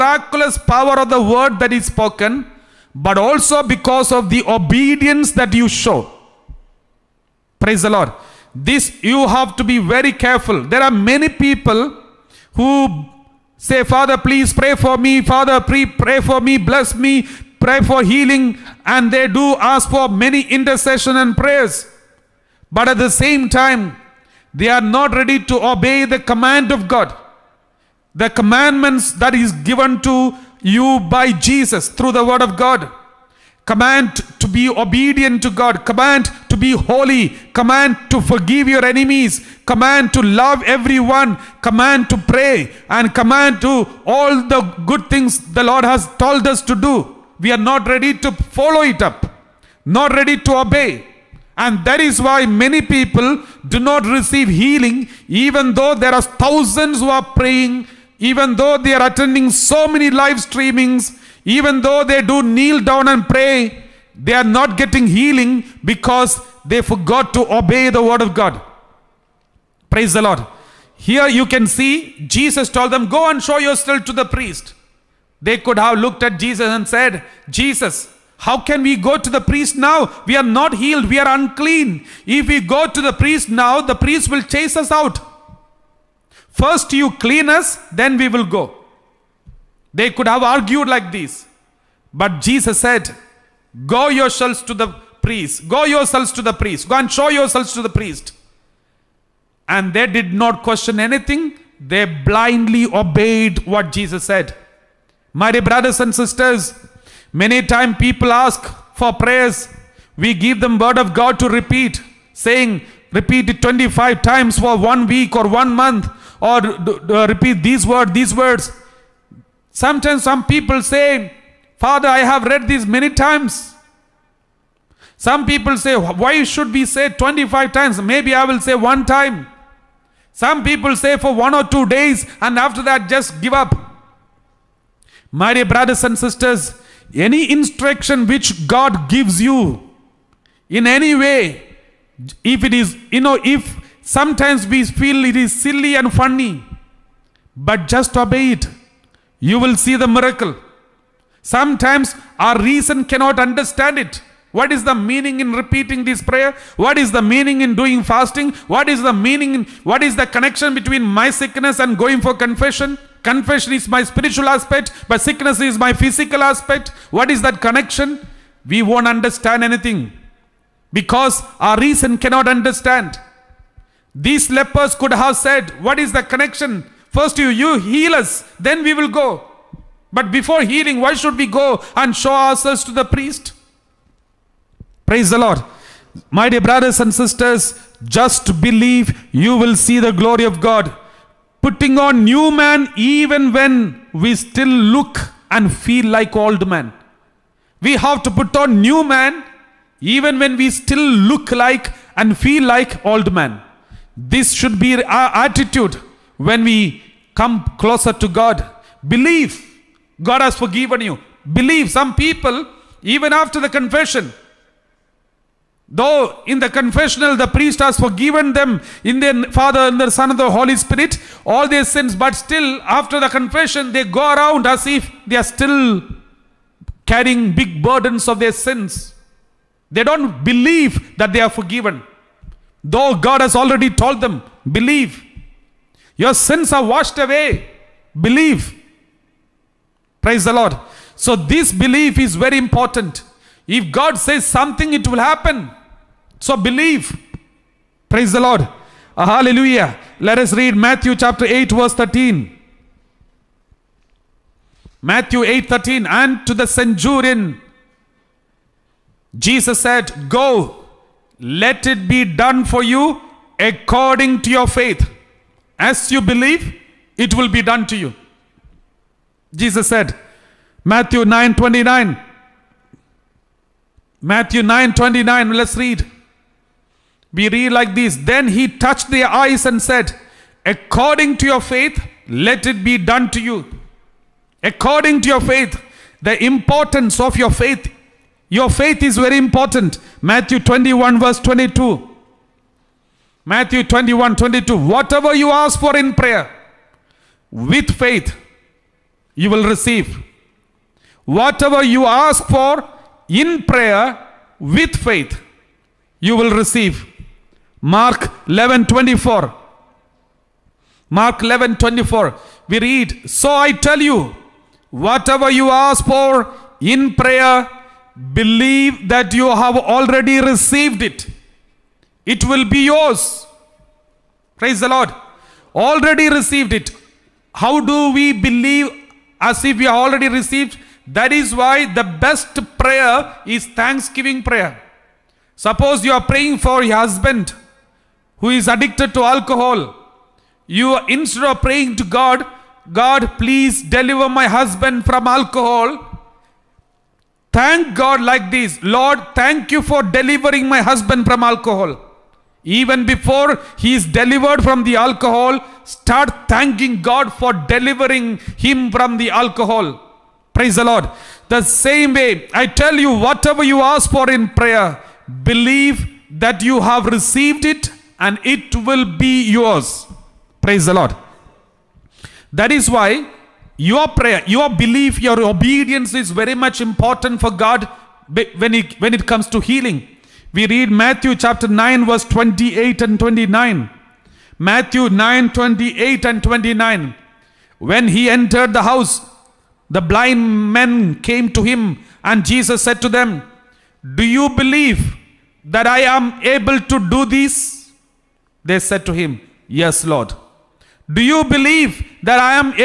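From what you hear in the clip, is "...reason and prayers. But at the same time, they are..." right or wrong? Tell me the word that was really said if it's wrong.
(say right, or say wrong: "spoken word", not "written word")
wrong: "intercession", not "reason".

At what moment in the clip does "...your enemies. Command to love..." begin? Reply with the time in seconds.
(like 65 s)
38 s.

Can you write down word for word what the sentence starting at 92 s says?
But Jesus said, Go yourselves to the priest.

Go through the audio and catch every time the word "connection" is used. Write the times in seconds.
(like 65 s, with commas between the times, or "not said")
160 s, 167 s, 176 s.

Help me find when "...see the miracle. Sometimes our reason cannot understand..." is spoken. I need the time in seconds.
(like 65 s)
149 s.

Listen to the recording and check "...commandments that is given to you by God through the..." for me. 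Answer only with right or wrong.
wrong.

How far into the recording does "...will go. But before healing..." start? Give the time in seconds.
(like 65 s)
178 s.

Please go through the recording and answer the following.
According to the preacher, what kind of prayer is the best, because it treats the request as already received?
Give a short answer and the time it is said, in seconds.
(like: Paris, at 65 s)
thanksgiving prayer, at 333 s.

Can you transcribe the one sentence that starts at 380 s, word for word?
We read Matthew chapter 9 verse 28 and 29.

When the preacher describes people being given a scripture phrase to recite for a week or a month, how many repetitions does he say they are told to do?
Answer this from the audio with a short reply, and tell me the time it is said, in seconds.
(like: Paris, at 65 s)
25, at 113 s.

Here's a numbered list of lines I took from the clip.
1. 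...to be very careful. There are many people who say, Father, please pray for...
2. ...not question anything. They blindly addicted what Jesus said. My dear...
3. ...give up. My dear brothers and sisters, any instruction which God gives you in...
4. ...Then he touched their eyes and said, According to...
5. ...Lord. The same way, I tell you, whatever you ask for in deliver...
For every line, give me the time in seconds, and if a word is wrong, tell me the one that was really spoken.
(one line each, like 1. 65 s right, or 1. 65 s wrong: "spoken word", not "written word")
1. 9 s right
2. 100 s wrong: "obeyed", not "addicted"
3. 133 s right
4. 278 s right
5. 360 s wrong: "prayer", not "deliver".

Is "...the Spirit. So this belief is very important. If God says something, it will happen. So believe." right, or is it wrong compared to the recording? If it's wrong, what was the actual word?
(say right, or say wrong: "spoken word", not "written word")
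wrong: "Lord", not "Spirit".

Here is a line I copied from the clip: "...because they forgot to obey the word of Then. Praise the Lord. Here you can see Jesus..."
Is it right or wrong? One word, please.
wrong.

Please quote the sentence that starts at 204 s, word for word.
This should be our attitude when we come closer to God.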